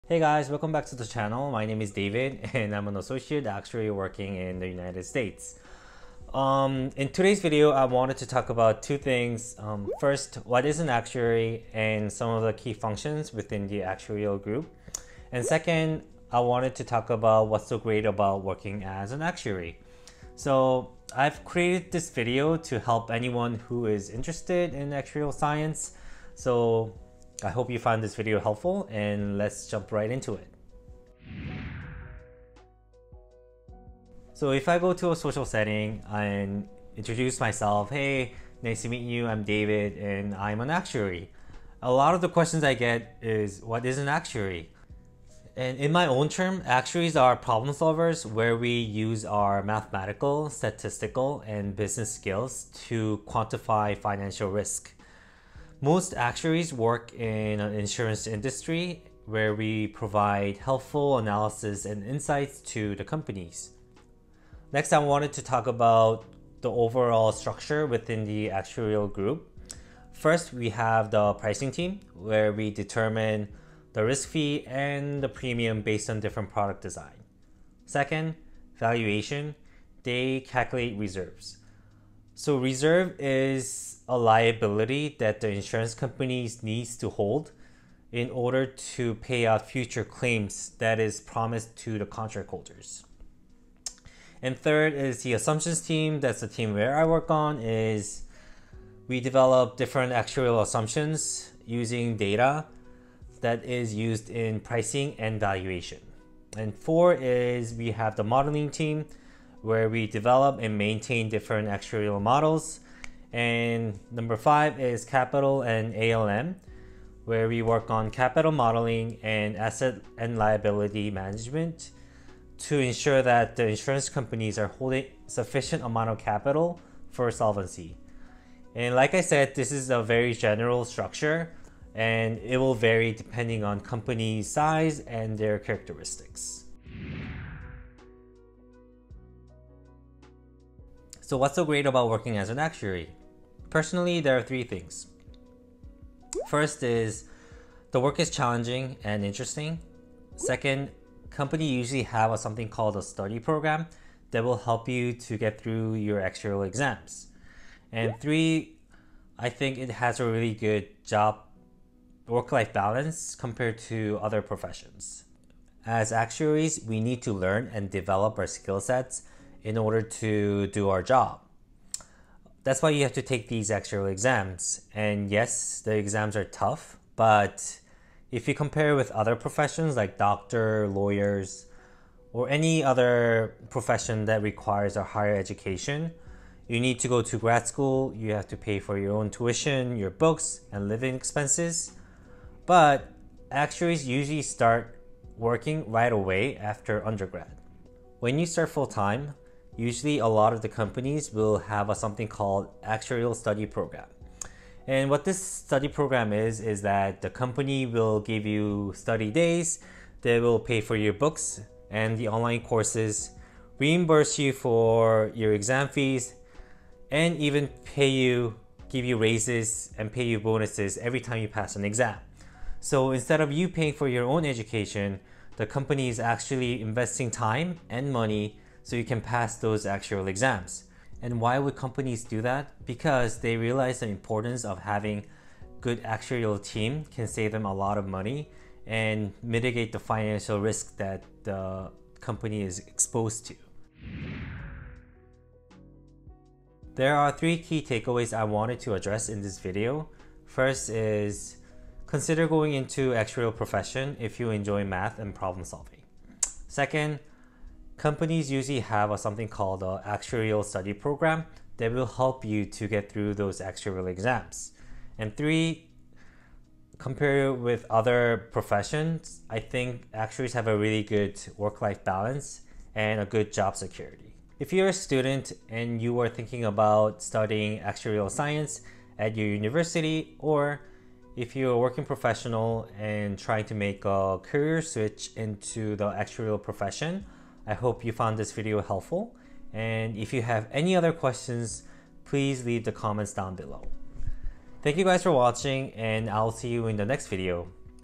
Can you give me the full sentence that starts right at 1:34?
And third is the assumptions team.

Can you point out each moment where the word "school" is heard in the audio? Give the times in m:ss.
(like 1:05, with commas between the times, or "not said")
3:07.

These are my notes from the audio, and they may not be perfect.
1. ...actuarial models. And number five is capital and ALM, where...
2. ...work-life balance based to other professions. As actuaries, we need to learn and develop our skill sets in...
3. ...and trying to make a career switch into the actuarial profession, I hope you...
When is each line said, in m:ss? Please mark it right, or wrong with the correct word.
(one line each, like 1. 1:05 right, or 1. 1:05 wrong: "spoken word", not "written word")
1. 1:51 right
2. 2:42 wrong: "compared", not "based"
3. 4:42 right.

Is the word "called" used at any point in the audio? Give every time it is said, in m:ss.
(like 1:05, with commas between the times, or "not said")
2:32, 3:22, 4:19.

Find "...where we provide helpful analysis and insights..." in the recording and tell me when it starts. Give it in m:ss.
0:59.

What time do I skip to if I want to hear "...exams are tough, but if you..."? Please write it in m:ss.
2:55.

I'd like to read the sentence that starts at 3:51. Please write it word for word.
And why would companies do that?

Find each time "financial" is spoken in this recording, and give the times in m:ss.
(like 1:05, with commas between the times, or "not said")
0:53, 3:59.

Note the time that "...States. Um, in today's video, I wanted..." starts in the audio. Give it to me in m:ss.
0:05.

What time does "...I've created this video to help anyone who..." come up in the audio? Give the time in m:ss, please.
0:21.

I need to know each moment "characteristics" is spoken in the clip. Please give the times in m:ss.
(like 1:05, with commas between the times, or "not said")
2:15.